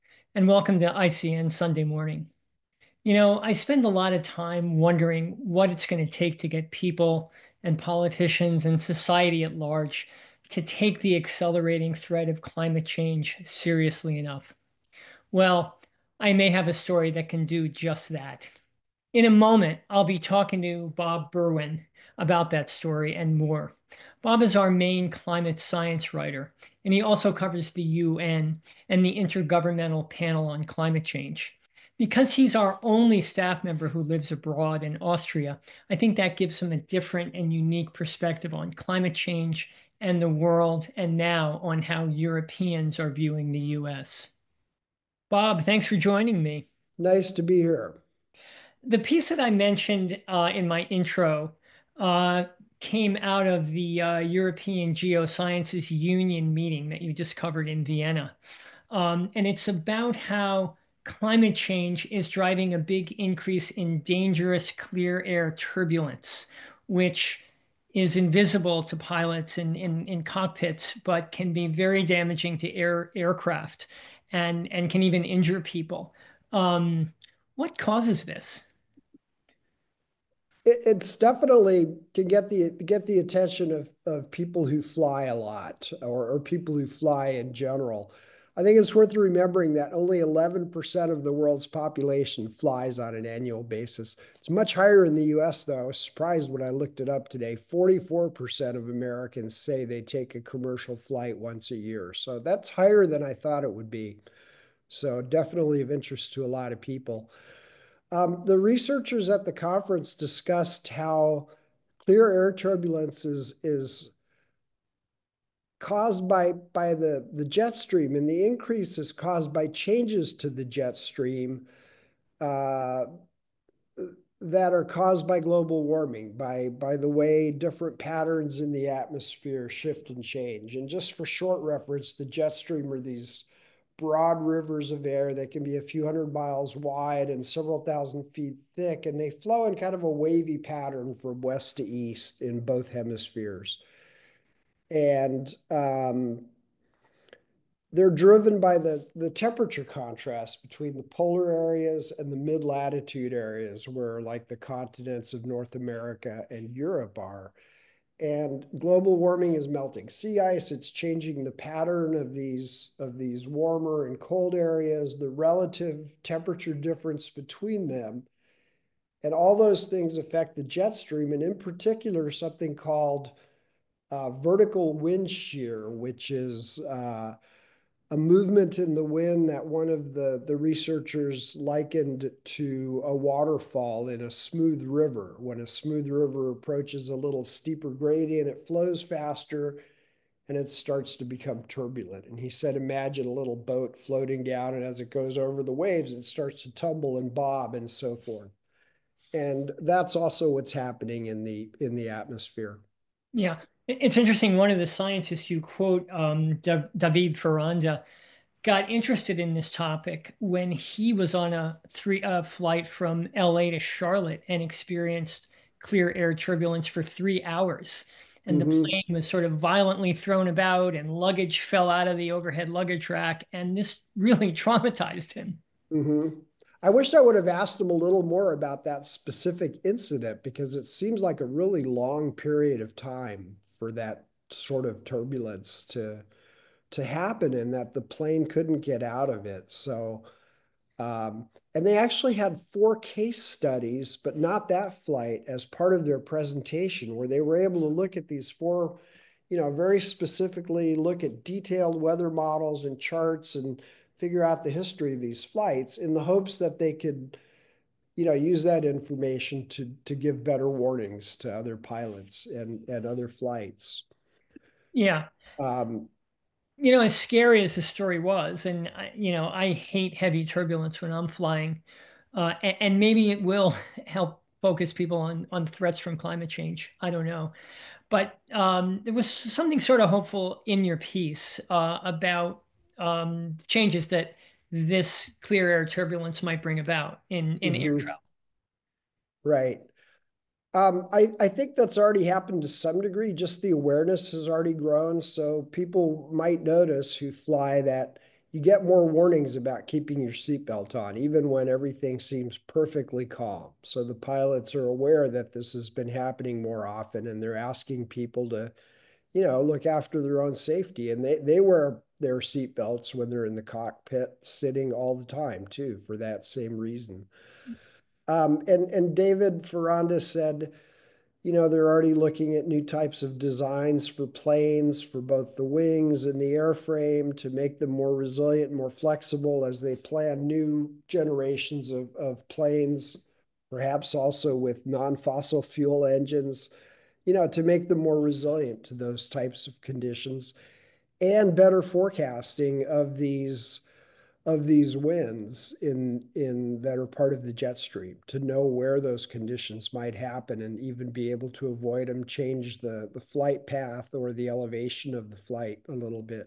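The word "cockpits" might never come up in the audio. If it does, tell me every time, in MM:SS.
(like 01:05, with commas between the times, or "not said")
01:10, 05:13.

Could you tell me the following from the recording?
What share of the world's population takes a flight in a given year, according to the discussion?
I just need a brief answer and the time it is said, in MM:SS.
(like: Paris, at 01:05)
11%, at 01:30.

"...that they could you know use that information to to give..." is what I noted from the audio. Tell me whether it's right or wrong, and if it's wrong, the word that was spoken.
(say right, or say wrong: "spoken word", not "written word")
right.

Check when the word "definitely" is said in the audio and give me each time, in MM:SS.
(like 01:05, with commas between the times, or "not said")
01:21, 01:45.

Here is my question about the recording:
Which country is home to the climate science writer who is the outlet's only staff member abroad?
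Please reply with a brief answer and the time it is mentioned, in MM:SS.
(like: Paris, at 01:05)
Austria, at 00:35.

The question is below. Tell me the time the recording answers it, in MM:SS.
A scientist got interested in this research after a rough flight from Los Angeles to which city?
03:33.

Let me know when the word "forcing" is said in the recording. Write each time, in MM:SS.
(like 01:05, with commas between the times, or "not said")
not said.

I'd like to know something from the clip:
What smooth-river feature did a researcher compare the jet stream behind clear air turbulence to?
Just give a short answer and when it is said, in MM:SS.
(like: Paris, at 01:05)
A waterfall, at 03:03.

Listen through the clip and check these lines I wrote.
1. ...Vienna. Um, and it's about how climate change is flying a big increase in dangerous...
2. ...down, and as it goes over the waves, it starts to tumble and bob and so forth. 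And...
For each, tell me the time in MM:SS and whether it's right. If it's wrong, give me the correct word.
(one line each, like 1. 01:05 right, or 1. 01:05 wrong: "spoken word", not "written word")
1. 00:57 wrong: "driving", not "flying"
2. 03:14 right.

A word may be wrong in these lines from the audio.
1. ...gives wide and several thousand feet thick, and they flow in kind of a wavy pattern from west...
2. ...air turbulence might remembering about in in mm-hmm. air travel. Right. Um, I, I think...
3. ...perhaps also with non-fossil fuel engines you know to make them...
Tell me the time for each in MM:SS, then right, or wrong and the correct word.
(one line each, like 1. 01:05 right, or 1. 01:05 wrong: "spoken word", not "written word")
1. 02:16 wrong: "miles", not "gives"
2. 04:45 wrong: "bring", not "remembering"
3. 05:33 right.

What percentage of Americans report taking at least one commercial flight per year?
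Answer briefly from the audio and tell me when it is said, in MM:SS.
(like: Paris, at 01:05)
44%, at 01:37.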